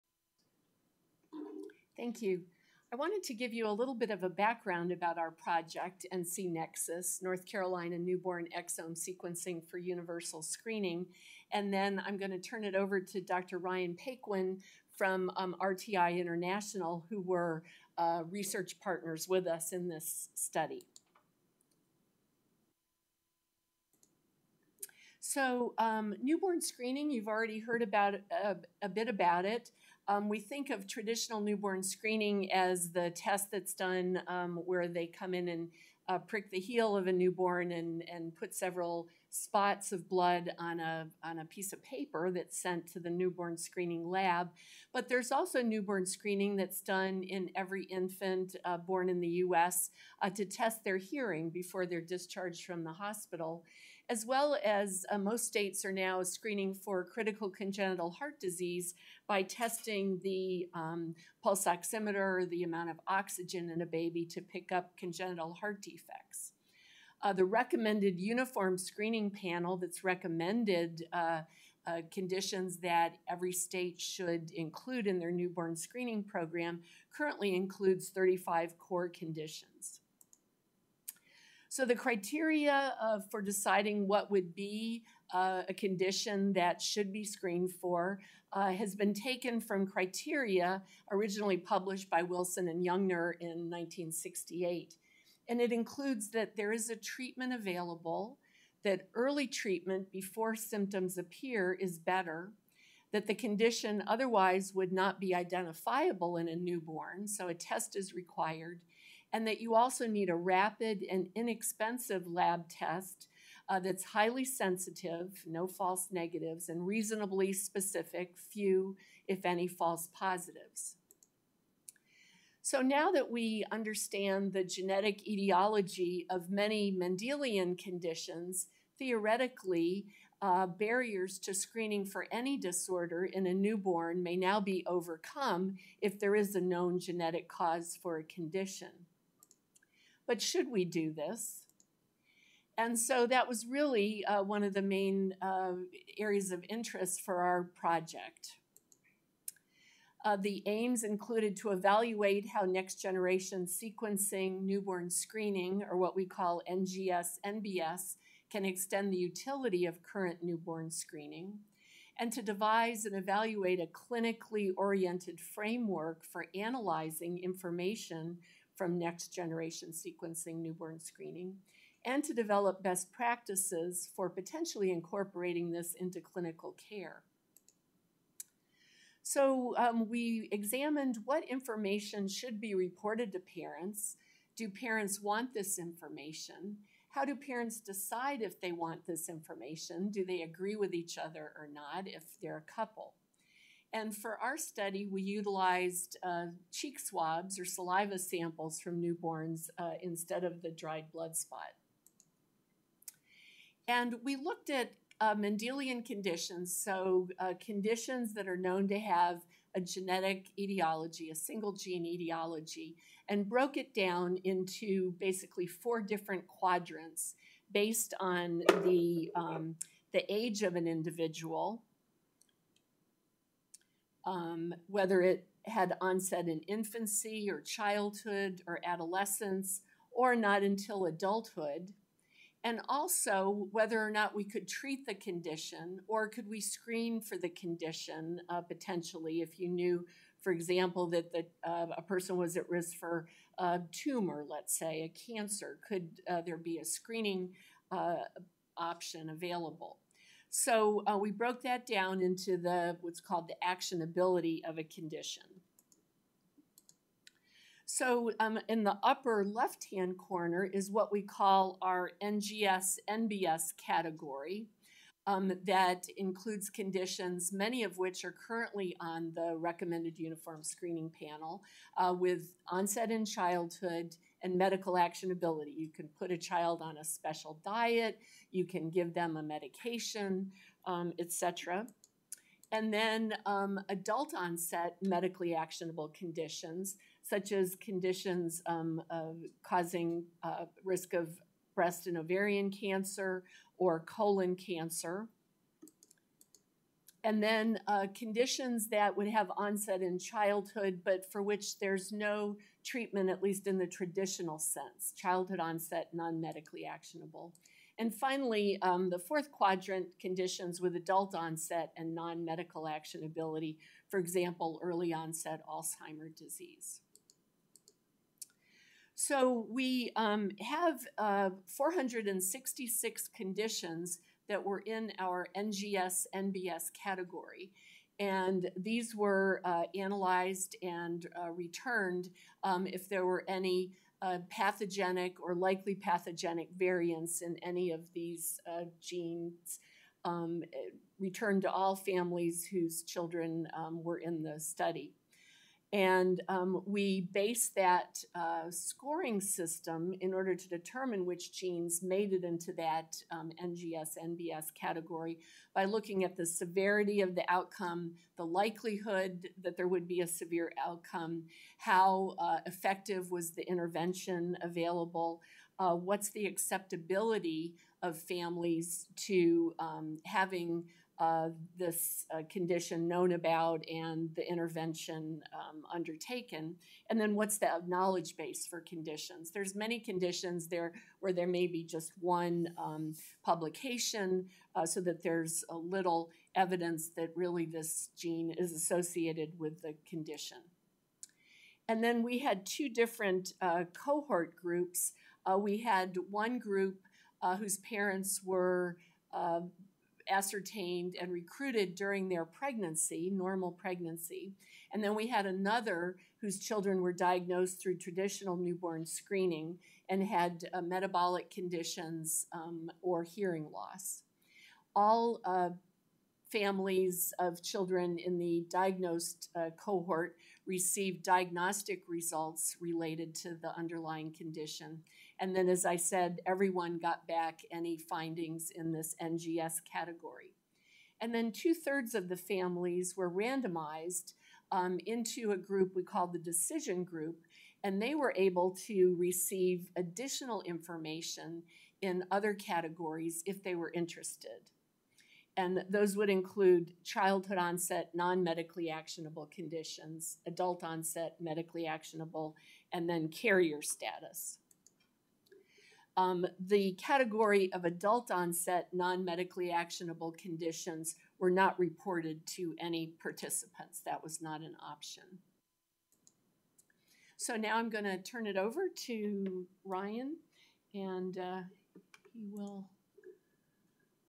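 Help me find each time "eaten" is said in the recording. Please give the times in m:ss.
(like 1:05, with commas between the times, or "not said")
not said.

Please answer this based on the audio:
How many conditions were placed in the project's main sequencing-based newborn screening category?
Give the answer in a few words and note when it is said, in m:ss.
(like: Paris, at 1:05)
466, at 5:21.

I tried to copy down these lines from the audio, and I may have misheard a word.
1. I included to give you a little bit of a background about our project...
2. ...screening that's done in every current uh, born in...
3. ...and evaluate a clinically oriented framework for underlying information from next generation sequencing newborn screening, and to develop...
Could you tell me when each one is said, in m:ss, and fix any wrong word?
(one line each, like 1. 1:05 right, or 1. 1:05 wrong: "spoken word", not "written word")
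1. 0:02 wrong: "wanted", not "included"
2. 0:46 wrong: "infant", not "current"
3. 2:43 wrong: "analyzing", not "underlying".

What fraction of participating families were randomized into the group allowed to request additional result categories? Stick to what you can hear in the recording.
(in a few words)
Two thirds.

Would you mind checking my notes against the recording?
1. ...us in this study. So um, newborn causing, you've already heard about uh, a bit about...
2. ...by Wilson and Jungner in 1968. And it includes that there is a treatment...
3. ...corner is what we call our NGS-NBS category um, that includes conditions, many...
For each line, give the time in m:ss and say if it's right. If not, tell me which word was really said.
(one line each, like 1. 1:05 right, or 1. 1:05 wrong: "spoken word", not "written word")
1. 0:19 wrong: "screening", not "causing"
2. 1:32 right
3. 4:20 right.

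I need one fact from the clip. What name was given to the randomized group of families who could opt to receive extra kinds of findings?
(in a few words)
Decision group.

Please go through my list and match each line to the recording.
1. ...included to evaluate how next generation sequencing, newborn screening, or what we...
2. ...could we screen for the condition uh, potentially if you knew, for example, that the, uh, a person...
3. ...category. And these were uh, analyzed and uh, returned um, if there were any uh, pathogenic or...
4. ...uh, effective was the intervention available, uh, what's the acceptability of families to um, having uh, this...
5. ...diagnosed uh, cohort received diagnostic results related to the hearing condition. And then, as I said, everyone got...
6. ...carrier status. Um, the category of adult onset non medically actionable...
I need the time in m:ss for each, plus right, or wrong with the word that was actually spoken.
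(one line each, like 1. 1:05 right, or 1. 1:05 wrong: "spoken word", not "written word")
1. 2:31 right
2. 3:56 right
3. 5:26 right
4. 6:02 right
5. 6:58 wrong: "underlying", not "hearing"
6. 7:33 right.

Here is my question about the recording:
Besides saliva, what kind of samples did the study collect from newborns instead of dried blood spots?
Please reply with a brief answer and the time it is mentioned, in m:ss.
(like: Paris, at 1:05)
Cheek swabs, at 3:16.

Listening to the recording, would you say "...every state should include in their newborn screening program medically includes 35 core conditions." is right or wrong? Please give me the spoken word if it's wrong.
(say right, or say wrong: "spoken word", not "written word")
wrong: "currently", not "medically".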